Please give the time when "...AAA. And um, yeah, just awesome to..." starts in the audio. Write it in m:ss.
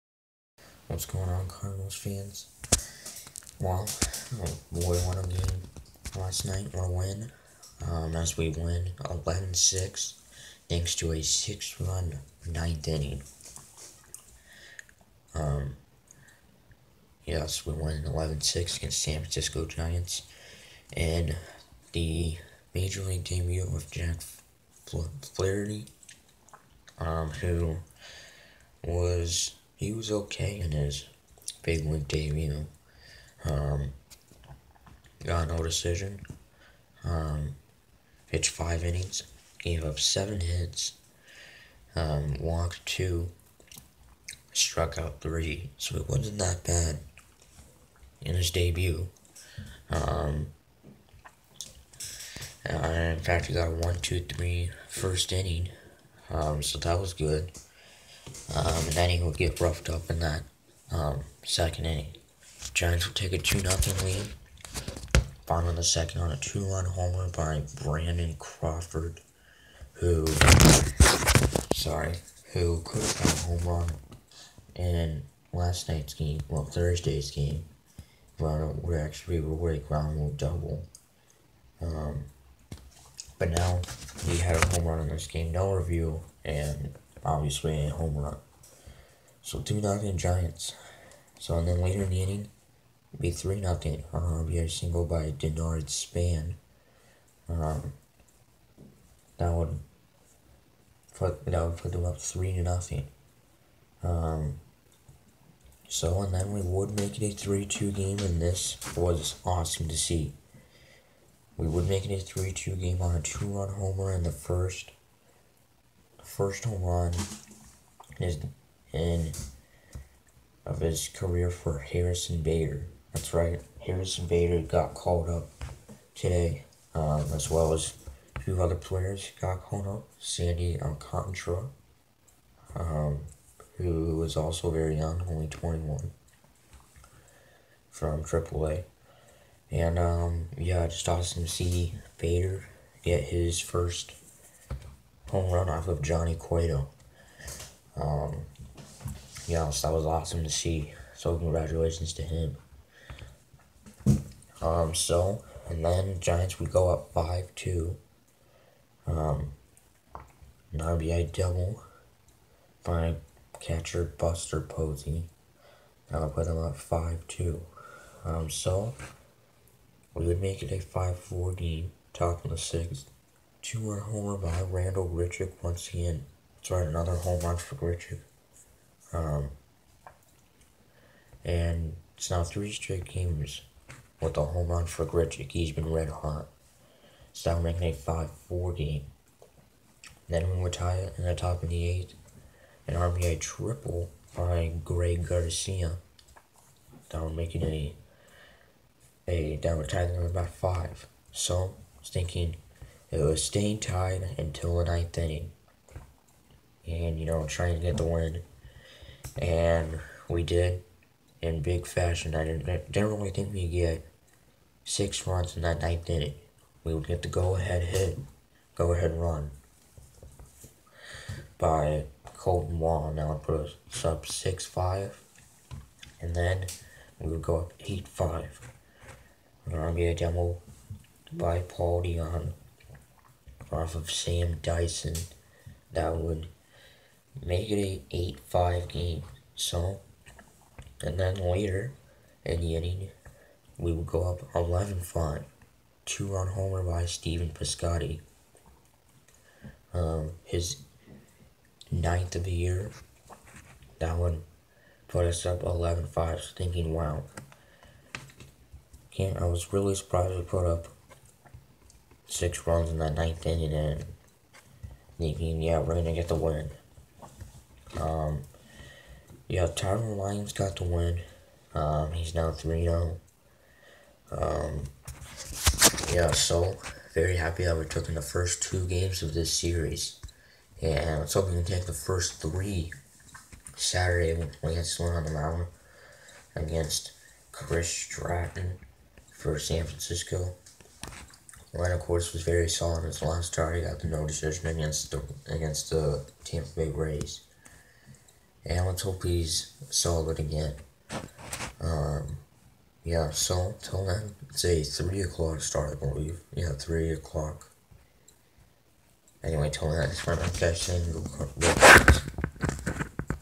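2:18.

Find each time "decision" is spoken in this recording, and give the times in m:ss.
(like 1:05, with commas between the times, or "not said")
0:35, 4:54.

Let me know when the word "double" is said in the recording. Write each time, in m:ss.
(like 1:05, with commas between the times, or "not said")
1:20, 2:41.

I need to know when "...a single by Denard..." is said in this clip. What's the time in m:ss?
1:34.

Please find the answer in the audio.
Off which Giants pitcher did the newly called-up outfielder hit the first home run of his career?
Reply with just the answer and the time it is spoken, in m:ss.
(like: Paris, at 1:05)
Johnny Cueto, at 2:26.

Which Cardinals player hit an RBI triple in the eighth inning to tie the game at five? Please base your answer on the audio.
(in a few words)
Greg Garcia.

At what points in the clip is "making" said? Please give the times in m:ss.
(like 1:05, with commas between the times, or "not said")
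3:07, 3:17.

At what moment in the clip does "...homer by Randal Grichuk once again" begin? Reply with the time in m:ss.
2:53.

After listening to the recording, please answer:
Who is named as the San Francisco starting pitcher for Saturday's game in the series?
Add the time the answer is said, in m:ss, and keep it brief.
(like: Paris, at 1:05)
Chris Stratton, at 4:47.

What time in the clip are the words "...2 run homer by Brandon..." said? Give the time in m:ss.
1:06.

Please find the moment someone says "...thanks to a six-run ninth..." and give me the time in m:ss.
0:10.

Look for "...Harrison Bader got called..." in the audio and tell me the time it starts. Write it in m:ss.
2:03.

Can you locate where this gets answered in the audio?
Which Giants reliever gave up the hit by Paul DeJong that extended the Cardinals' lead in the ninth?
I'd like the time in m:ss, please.
3:54.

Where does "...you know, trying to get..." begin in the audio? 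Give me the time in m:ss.
3:27.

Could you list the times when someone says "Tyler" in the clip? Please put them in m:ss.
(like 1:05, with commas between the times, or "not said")
4:29.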